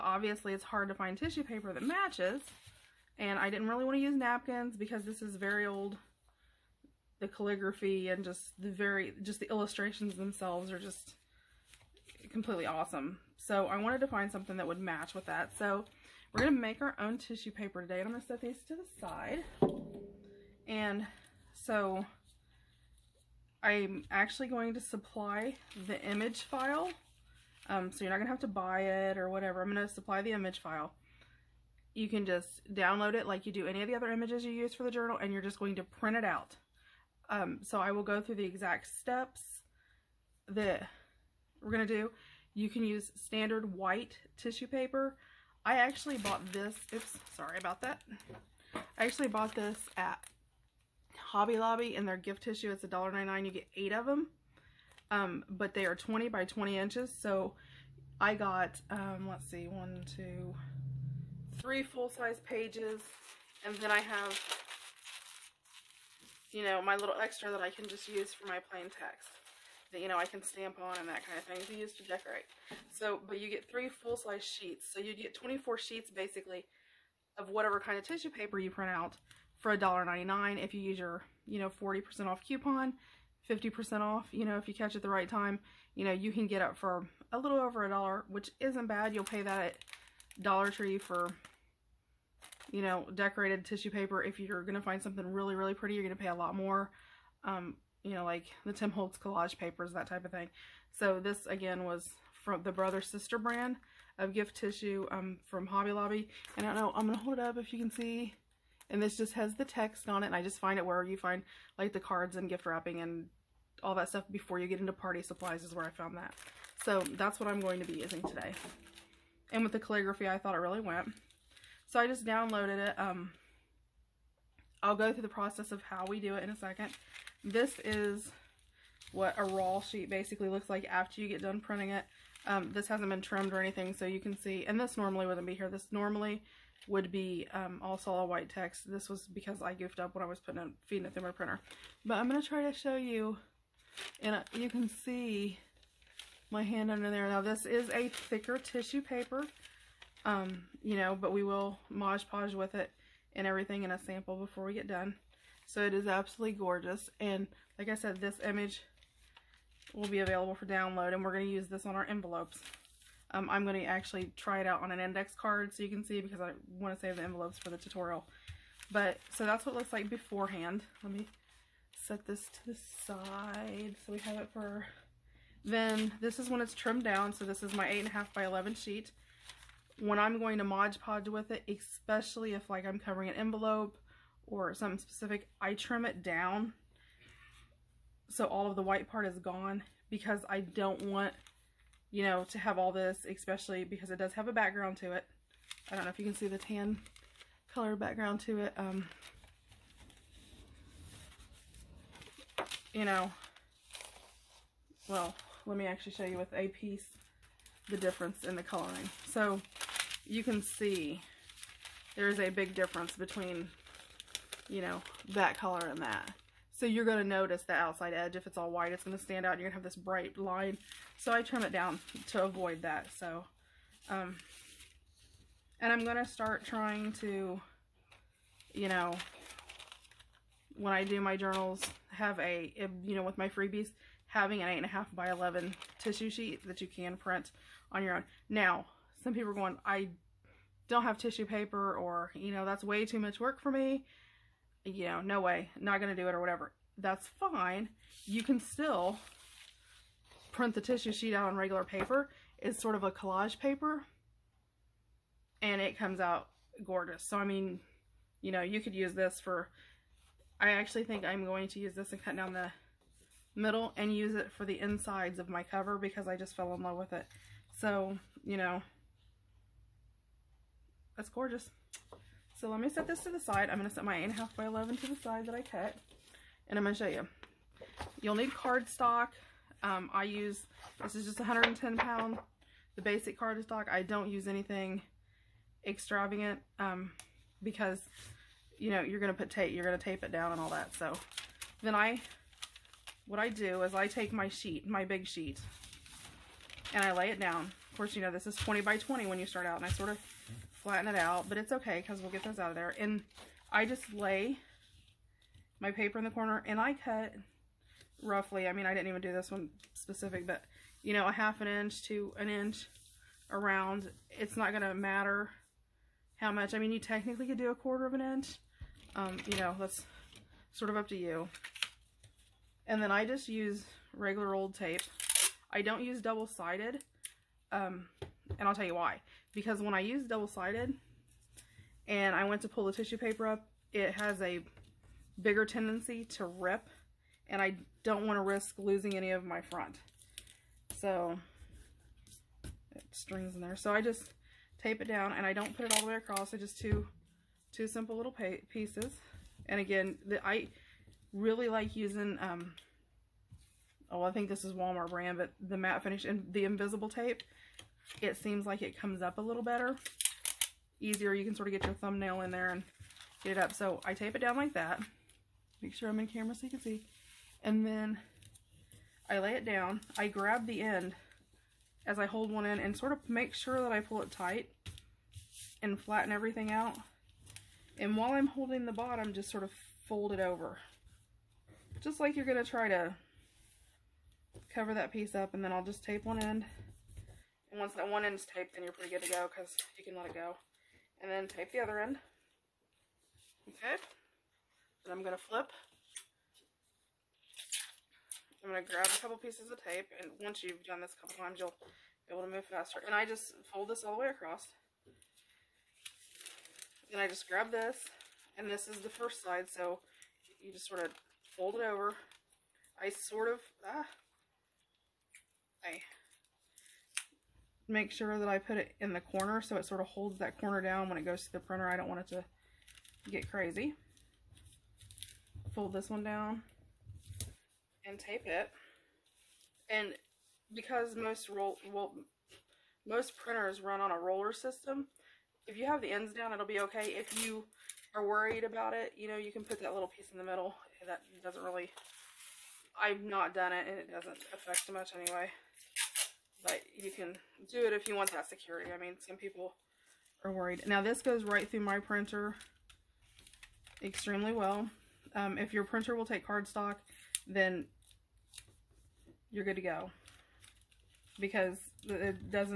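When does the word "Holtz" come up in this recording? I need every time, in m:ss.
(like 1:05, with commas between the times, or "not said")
1:38.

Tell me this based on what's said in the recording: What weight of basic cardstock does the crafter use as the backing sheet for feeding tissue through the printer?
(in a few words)
110 pound.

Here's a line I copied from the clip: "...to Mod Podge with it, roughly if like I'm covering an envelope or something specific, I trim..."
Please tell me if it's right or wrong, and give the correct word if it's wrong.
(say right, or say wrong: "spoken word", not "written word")
wrong: "especially", not "roughly".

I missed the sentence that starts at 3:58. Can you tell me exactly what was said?
Now, some people are going, I don't have tissue paper or, you know, that's way too much work for me.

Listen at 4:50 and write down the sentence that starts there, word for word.
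So then I, what I do is I take my sheet, my big sheet, and I lay it down.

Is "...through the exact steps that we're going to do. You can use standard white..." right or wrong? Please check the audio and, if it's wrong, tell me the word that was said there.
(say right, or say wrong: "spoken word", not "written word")
right.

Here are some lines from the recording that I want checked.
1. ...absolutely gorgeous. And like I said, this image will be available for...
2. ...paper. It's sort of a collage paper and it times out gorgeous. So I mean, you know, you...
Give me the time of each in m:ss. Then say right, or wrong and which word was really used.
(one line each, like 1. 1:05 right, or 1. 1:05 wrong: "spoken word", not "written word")
1. 2:36 right
2. 4:11 wrong: "comes", not "times".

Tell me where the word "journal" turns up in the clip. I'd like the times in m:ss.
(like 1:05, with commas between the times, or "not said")
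0:34, 3:51.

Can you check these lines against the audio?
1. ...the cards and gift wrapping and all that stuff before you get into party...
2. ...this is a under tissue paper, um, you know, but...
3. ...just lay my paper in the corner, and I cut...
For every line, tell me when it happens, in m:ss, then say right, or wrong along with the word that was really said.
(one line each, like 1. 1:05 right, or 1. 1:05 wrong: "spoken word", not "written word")
1. 1:51 right
2. 2:27 wrong: "thicker", not "under"
3. 5:03 right.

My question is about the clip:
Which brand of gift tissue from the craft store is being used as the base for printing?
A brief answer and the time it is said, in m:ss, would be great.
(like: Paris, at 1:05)
Brother Sister, at 1:42.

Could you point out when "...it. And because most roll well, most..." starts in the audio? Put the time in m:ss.
7:08.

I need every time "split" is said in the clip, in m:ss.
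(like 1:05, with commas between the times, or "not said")
not said.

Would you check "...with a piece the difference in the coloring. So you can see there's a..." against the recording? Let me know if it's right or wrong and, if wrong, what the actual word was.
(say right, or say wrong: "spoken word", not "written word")
right.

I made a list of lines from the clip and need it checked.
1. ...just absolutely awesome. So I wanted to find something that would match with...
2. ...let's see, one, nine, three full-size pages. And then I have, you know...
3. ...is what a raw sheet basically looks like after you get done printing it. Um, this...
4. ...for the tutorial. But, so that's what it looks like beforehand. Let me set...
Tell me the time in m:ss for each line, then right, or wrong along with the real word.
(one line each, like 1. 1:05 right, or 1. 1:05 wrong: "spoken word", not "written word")
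1. 0:10 wrong: "completely", not "absolutely"
2. 0:59 wrong: "two", not "nine"
3. 2:07 right
4. 2:47 right.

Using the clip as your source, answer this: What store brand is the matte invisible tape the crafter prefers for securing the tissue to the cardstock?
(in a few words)
Walmart.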